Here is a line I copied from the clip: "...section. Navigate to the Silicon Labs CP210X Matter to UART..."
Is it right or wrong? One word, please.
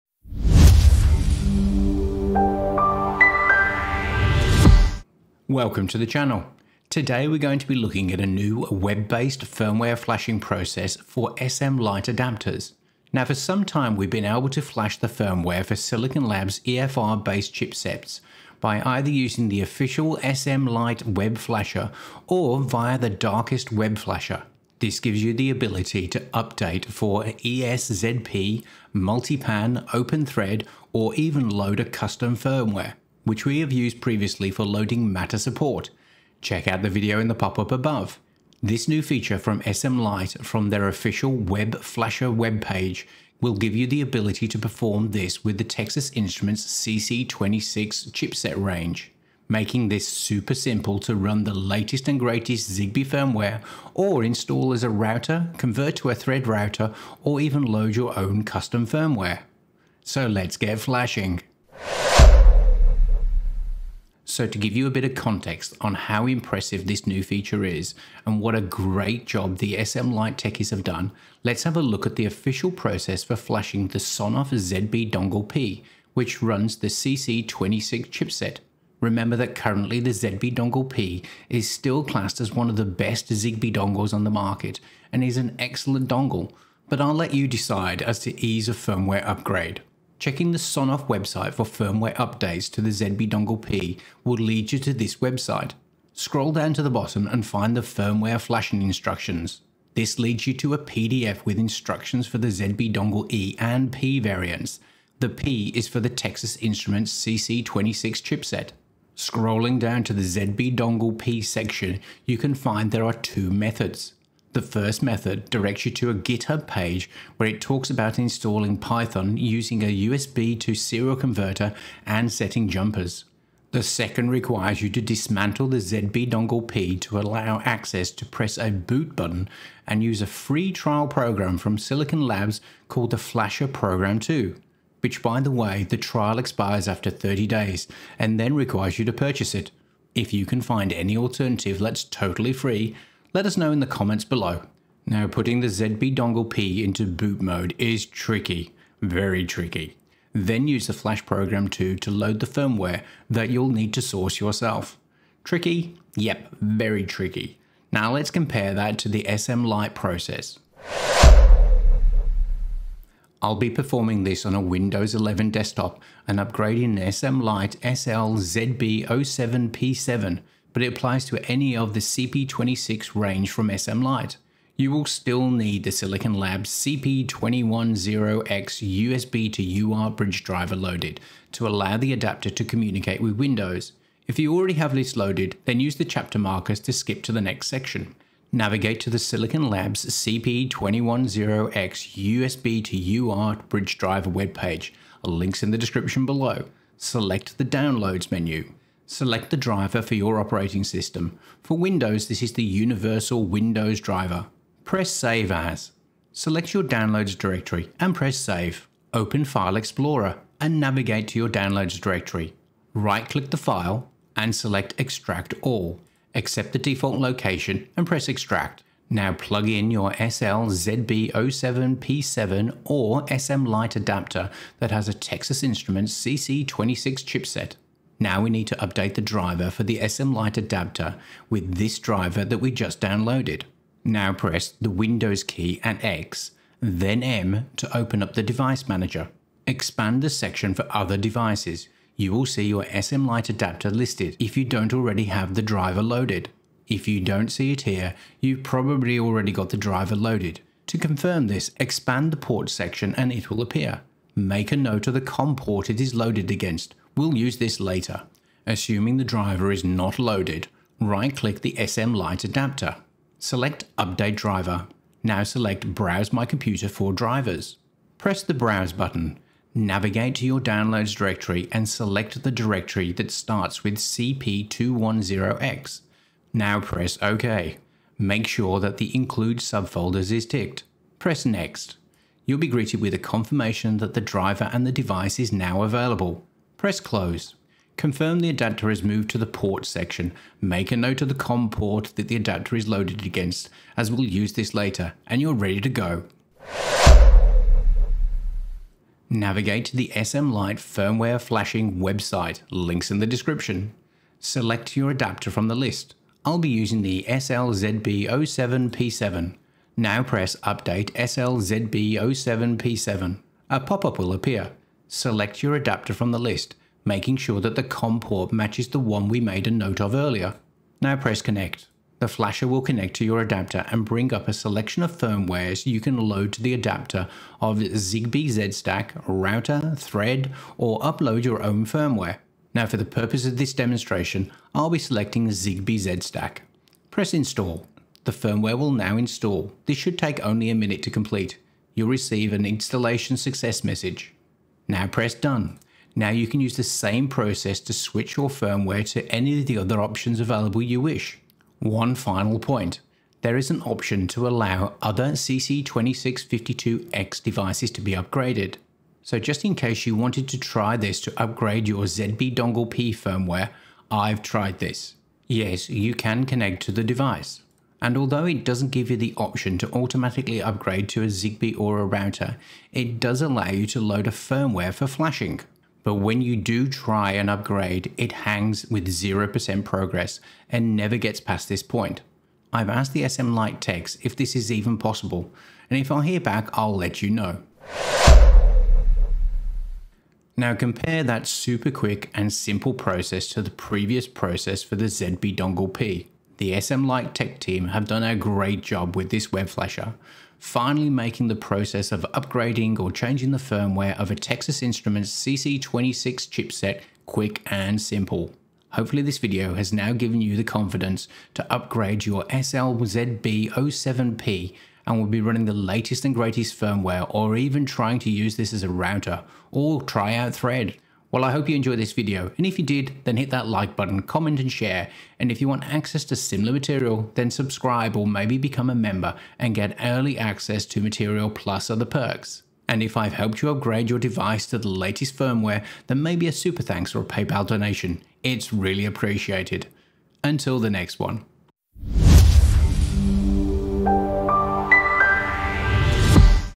wrong.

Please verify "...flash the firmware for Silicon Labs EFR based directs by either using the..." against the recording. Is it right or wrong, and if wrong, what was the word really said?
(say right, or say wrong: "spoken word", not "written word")
wrong: "chipsets", not "directs".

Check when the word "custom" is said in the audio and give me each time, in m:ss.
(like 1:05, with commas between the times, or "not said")
0:31, 0:58.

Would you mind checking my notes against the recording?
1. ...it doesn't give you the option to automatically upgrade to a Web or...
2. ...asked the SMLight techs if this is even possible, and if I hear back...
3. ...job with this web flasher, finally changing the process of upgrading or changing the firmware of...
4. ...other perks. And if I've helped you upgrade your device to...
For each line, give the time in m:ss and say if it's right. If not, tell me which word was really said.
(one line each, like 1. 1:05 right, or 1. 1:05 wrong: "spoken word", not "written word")
1. 6:08 wrong: "Zigbee", not "Web"
2. 6:22 right
3. 6:38 wrong: "making", not "changing"
4. 7:11 right.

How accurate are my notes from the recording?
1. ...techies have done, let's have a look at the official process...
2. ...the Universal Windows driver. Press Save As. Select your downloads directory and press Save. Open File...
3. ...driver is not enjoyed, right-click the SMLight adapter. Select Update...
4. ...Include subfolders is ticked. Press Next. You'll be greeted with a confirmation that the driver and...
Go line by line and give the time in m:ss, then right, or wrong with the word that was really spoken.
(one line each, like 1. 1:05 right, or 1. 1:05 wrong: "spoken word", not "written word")
1. 1:10 right
2. 3:22 right
3. 4:19 wrong: "loaded", not "enjoyed"
4. 4:39 right.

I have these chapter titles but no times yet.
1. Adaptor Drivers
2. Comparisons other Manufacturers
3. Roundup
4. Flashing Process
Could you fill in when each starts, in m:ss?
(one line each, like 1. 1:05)
1. 2:40
2. 1:02
3. 6:28
4. 4:56.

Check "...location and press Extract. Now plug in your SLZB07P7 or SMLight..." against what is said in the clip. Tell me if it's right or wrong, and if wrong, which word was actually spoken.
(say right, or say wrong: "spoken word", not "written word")
right.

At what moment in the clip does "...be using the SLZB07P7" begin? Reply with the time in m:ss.
5:06.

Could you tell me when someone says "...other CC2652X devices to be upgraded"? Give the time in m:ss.
5:55.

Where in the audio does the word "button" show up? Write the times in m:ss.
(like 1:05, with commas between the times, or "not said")
2:09, 4:28, 7:03.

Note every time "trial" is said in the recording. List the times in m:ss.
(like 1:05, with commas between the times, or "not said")
2:10, 2:15.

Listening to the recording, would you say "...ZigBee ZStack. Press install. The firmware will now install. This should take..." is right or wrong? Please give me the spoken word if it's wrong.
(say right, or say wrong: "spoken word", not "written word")
right.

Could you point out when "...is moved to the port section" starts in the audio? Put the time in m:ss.
4:48.